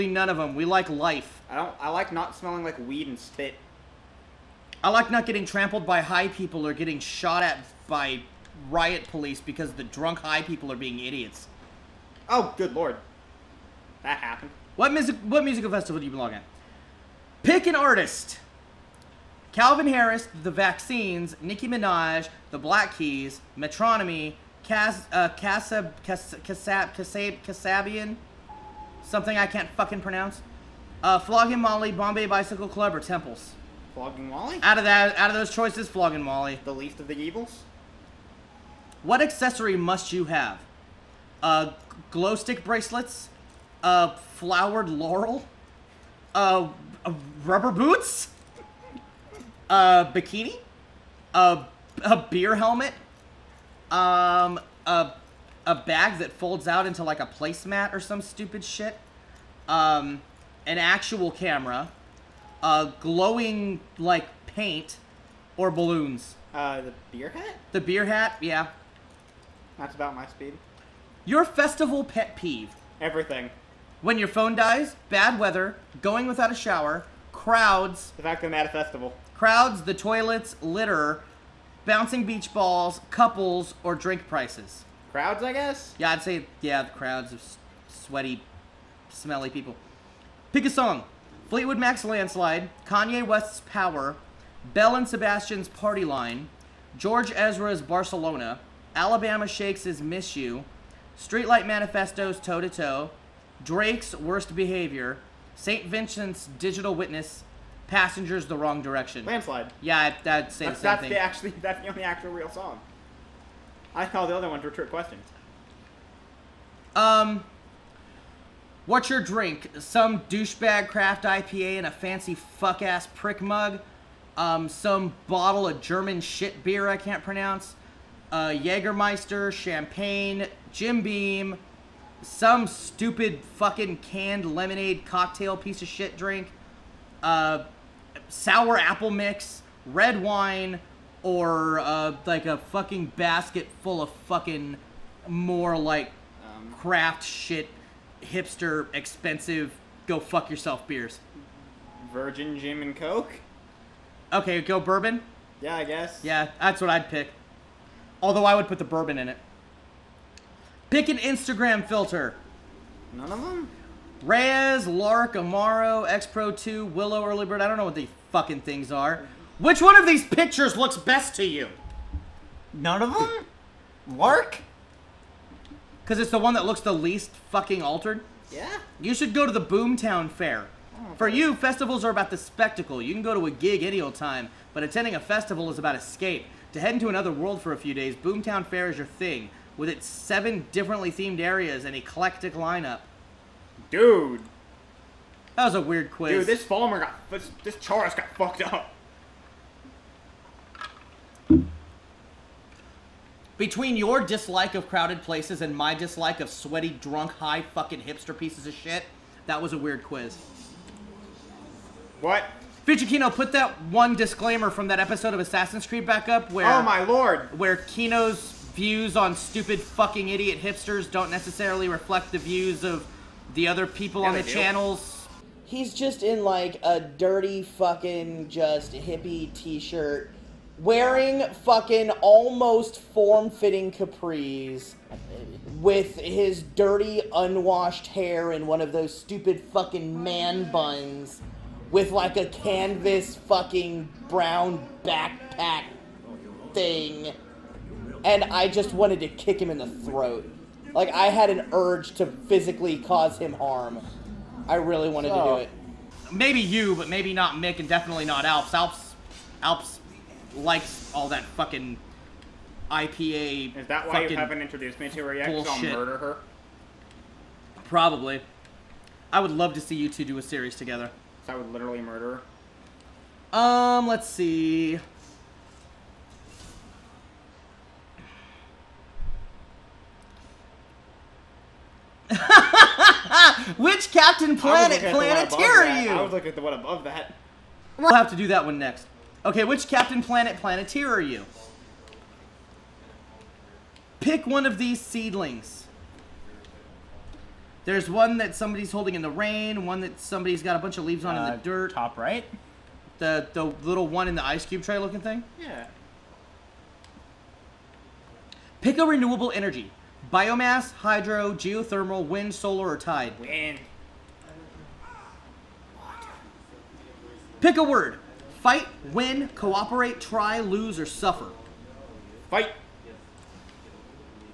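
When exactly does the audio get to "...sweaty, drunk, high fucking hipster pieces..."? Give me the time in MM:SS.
03:26.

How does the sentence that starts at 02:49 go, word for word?
Which one of these pictures looks best to you?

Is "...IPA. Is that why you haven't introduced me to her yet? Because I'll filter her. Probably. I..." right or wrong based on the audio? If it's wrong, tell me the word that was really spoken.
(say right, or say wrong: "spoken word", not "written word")
wrong: "murder", not "filter".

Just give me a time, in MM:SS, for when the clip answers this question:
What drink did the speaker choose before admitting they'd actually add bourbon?
02:32.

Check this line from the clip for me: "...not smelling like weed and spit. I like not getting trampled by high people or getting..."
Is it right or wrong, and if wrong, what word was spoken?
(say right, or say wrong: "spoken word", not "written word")
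right.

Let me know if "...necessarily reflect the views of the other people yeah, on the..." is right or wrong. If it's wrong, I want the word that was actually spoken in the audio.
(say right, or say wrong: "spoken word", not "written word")
right.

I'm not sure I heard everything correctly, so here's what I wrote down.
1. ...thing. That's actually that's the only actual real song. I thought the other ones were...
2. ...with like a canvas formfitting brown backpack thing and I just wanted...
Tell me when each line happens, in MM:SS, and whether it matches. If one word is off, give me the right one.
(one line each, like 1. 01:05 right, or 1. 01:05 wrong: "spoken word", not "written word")
1. 01:51 right
2. 04:01 wrong: "fucking", not "formfitting".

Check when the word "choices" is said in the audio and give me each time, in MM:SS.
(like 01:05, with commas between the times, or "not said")
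00:35.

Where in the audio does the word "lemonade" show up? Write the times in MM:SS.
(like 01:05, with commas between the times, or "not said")
02:14.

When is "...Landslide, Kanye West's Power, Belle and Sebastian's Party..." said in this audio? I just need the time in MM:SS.
01:32.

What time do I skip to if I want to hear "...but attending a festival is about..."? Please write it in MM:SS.
03:04.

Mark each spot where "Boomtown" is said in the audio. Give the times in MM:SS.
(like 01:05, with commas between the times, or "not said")
02:59, 03:08.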